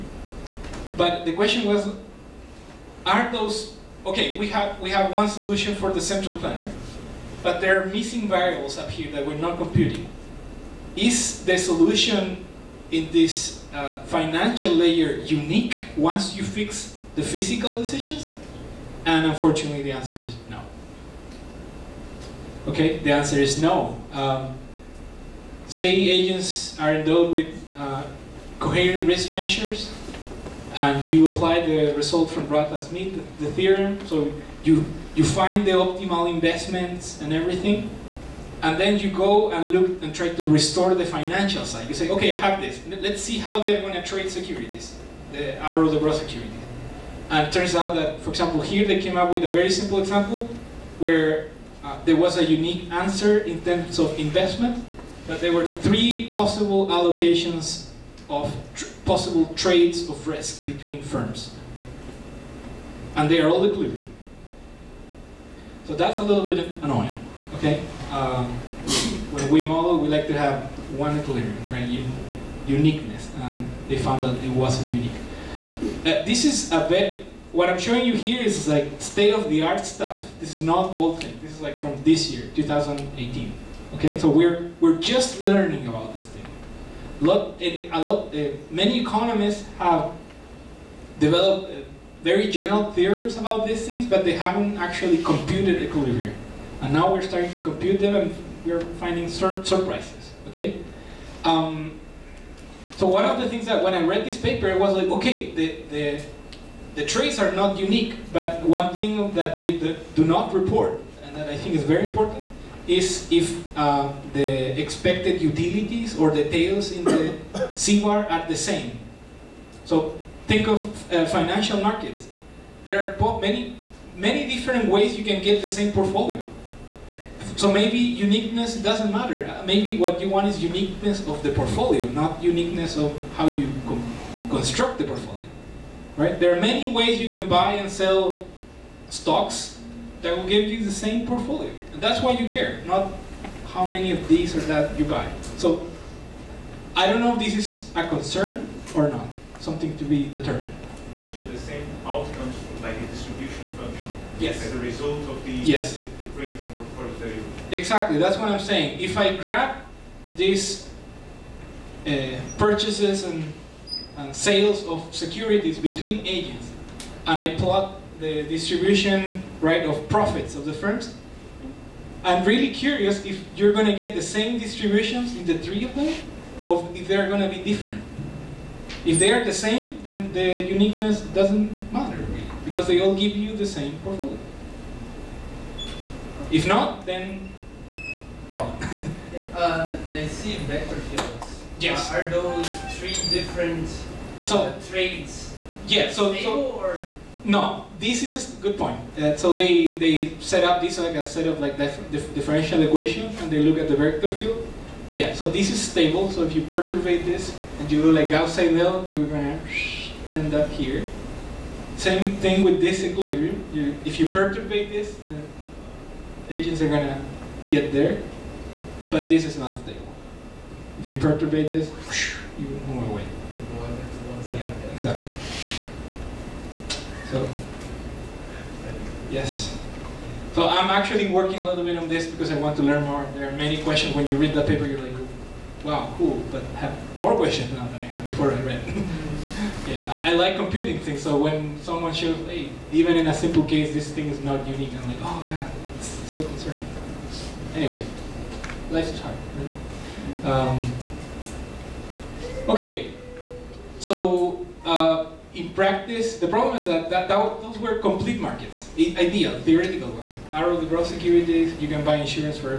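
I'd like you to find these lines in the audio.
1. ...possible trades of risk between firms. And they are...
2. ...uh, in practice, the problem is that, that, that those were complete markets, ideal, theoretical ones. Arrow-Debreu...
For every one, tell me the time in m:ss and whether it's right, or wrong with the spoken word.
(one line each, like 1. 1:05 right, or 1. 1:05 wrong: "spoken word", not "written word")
1. 0:59 right
2. 4:14 right.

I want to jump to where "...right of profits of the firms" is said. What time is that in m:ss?
2:49.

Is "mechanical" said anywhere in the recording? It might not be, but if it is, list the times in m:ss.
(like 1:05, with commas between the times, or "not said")
not said.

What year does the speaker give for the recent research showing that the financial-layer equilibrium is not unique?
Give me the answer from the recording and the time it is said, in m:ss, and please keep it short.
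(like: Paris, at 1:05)
2018, at 1:22.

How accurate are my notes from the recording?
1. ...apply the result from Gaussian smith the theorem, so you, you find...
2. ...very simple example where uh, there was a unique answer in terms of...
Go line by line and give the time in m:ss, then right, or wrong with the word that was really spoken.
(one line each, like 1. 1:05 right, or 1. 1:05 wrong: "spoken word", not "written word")
1. 0:31 wrong: "Bradley", not "Gaussian"
2. 0:49 right.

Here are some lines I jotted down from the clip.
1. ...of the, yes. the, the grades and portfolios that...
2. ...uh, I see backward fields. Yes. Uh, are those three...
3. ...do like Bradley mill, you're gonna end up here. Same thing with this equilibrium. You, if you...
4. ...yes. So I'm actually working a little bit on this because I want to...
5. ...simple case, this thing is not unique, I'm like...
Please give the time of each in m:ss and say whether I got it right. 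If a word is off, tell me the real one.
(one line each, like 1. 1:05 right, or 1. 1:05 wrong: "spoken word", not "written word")
1. 2:35 right
2. 3:09 right
3. 3:28 wrong: "Gaussian", not "Bradley"
4. 3:49 right
5. 4:03 right.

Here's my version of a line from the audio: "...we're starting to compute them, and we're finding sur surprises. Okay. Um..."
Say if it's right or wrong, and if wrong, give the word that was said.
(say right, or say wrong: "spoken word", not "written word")
right.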